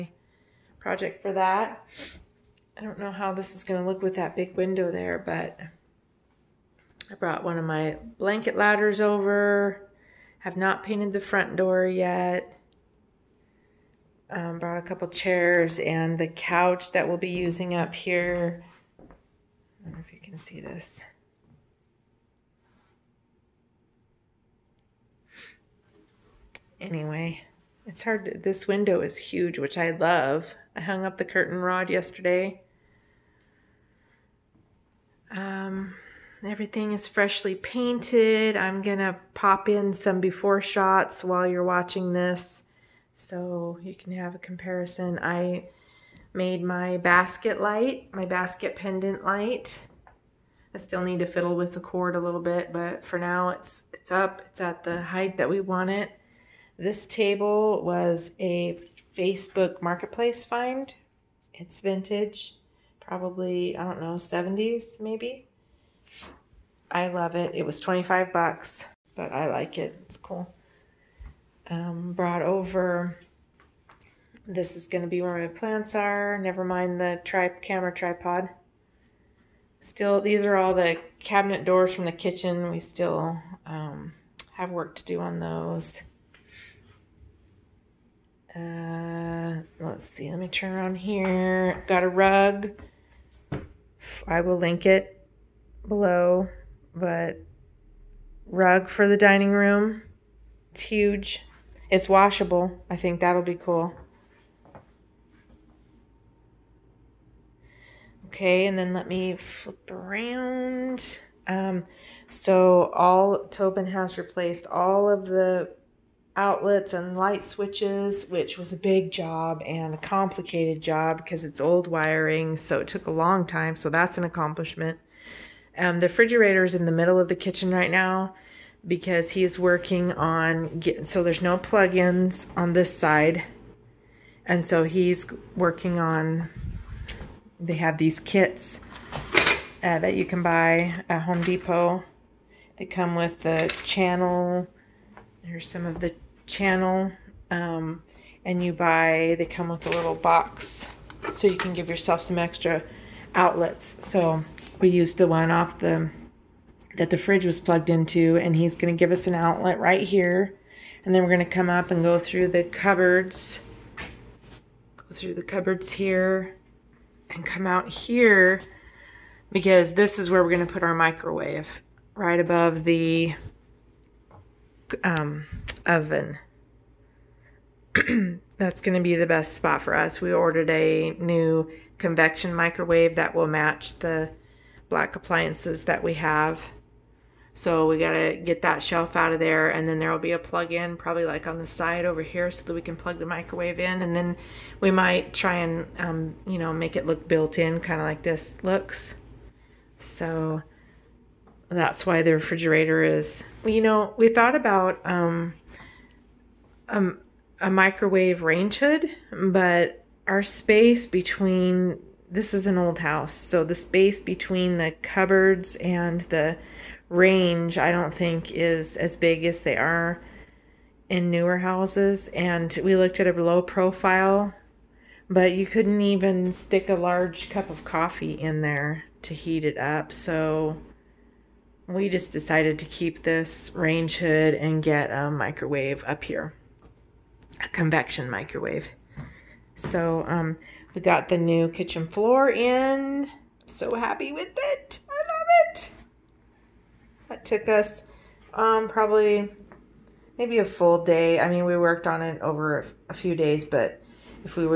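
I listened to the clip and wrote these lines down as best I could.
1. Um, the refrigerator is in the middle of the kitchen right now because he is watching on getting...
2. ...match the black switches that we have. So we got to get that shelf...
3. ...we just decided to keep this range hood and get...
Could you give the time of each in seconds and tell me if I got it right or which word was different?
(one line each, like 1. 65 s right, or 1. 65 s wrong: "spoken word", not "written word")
1. 125 s wrong: "working", not "watching"
2. 183 s wrong: "appliances", not "switches"
3. 231 s right.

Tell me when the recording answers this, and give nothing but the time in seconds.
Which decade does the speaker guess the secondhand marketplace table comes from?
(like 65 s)
64 s.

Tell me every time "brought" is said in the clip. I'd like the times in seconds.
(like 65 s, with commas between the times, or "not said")
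7 s, 14 s, 72 s.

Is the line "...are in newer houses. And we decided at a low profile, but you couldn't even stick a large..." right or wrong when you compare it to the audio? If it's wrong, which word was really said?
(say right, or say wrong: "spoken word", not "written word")
wrong: "looked", not "decided".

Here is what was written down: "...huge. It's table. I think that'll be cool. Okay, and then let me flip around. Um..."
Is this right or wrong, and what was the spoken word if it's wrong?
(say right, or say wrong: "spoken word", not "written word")
wrong: "washable", not "table".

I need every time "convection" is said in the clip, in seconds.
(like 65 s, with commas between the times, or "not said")
181 s, 237 s.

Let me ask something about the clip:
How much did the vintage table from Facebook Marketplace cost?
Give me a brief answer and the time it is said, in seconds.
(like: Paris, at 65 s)
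$25, at 67 s.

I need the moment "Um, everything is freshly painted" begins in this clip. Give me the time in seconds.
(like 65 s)
35 s.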